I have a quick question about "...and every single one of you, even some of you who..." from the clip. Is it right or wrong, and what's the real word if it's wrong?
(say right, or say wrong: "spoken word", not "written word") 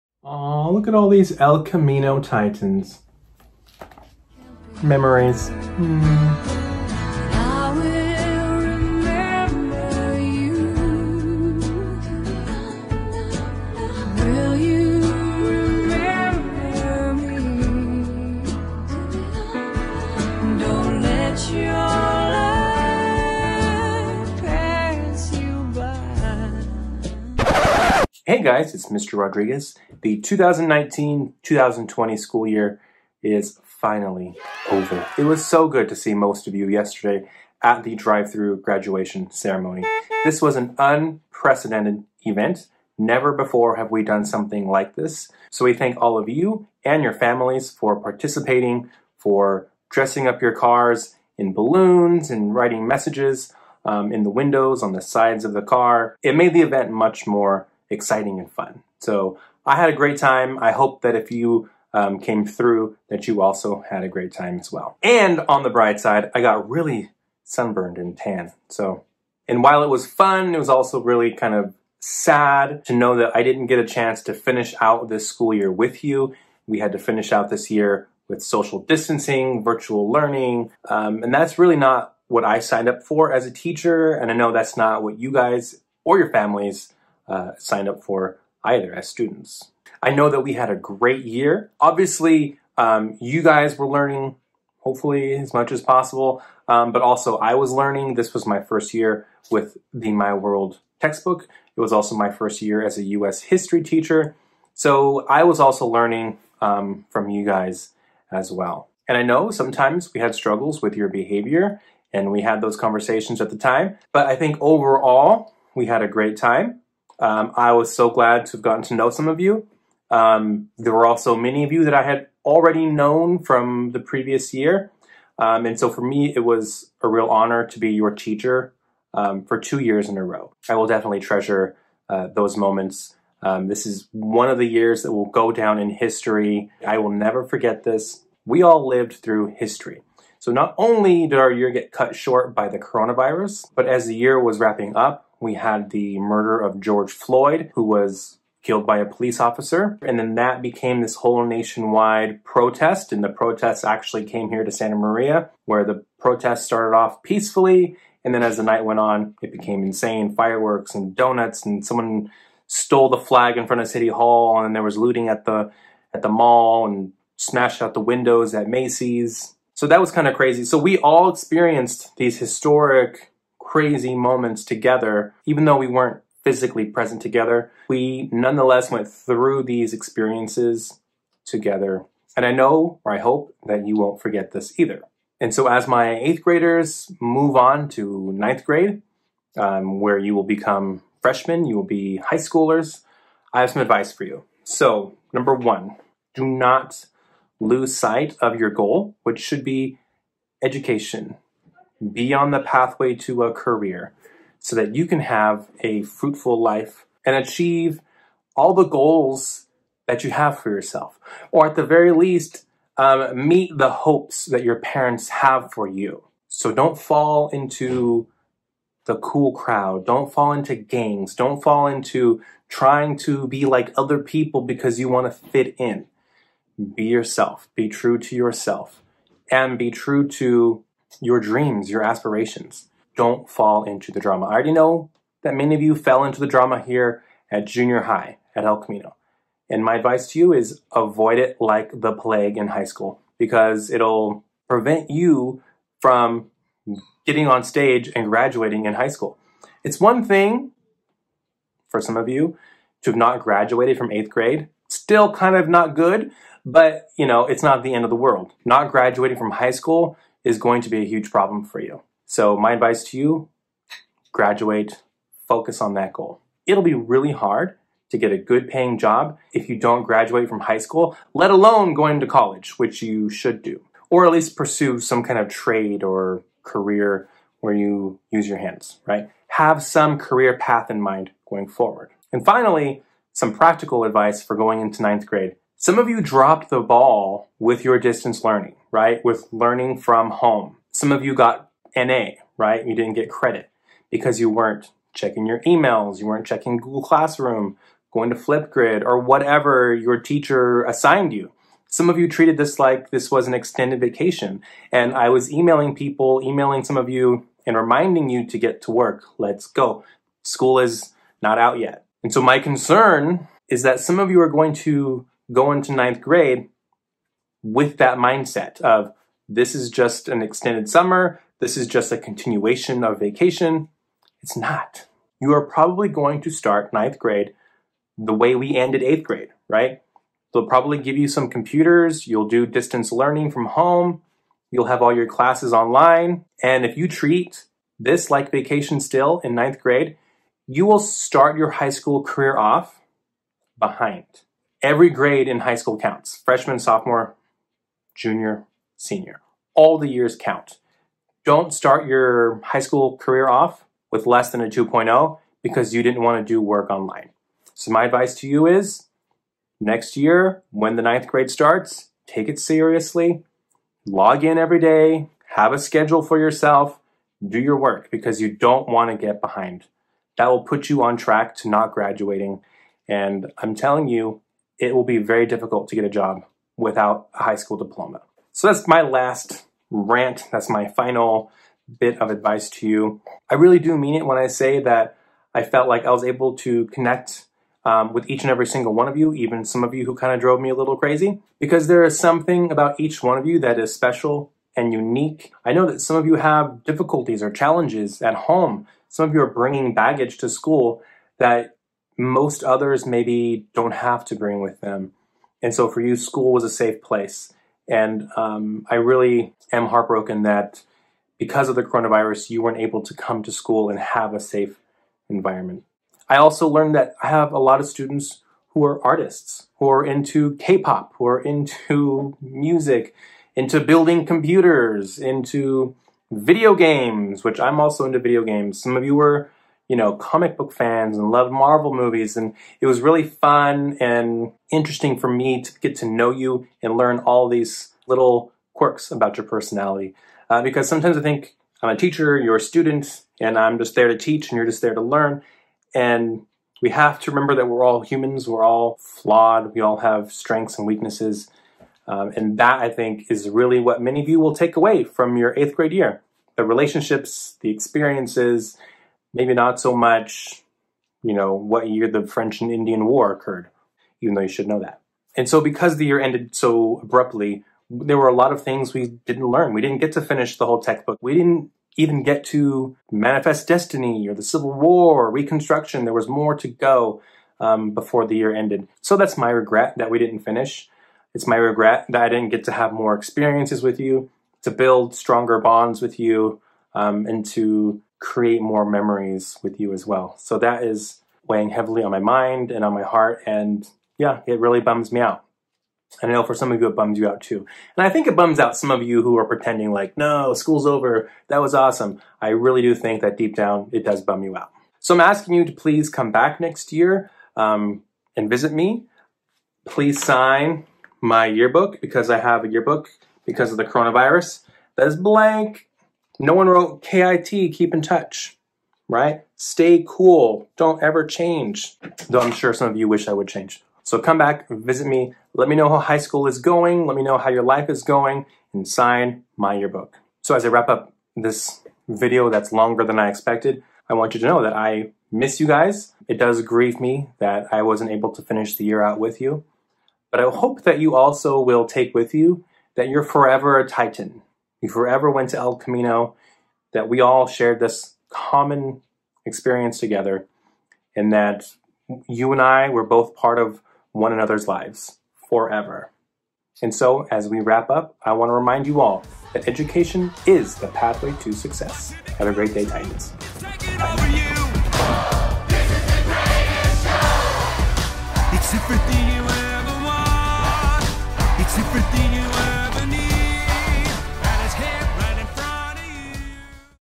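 right.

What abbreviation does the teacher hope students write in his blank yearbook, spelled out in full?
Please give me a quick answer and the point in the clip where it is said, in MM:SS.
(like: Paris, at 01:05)
Keep in touch, at 08:37.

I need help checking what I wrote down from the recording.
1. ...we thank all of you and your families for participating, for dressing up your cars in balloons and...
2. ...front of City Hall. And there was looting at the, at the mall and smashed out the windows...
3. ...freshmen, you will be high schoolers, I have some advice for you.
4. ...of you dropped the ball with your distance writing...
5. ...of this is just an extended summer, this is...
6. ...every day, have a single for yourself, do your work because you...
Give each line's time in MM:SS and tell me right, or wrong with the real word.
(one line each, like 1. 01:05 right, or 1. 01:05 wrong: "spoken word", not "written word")
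1. 00:45 right
2. 02:43 right
3. 03:11 right
4. 04:45 wrong: "learning", not "writing"
5. 05:18 right
6. 06:04 wrong: "schedule", not "single".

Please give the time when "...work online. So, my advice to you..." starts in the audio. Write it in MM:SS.
05:56.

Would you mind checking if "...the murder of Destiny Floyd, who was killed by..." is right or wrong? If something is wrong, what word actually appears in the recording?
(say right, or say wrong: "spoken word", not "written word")
wrong: "George", not "Destiny".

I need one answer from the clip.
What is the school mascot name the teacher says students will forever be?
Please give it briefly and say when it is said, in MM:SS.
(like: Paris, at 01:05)
Titan, at 09:03.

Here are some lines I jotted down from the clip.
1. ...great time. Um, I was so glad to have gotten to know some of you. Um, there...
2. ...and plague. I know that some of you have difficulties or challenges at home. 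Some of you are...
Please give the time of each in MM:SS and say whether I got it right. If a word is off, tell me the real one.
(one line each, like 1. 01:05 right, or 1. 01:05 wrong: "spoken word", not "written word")
1. 01:56 right
2. 06:34 wrong: "unique", not "plague".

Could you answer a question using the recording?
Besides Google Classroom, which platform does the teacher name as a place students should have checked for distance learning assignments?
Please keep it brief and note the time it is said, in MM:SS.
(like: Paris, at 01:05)
Flipgrid, at 04:58.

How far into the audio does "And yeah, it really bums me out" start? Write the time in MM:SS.
08:13.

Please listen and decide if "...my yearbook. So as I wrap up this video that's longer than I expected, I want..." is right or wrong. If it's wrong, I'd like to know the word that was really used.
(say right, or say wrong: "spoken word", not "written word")
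right.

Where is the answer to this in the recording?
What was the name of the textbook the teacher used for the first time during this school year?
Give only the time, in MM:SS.
01:40.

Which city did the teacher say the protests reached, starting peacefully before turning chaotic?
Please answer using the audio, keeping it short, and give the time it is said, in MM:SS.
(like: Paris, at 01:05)
Santa Maria, at 02:34.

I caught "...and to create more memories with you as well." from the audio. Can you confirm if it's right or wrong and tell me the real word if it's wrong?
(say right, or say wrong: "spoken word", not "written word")
right.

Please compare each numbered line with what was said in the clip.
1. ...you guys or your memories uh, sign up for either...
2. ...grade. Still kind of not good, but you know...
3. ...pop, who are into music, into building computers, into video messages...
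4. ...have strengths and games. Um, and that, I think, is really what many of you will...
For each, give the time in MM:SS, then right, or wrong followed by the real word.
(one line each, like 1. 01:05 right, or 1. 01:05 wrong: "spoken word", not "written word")
1. 01:25 wrong: "families", not "memories"
2. 04:14 right
3. 07:00 wrong: "games", not "messages"
4. 07:29 wrong: "weaknesses", not "games".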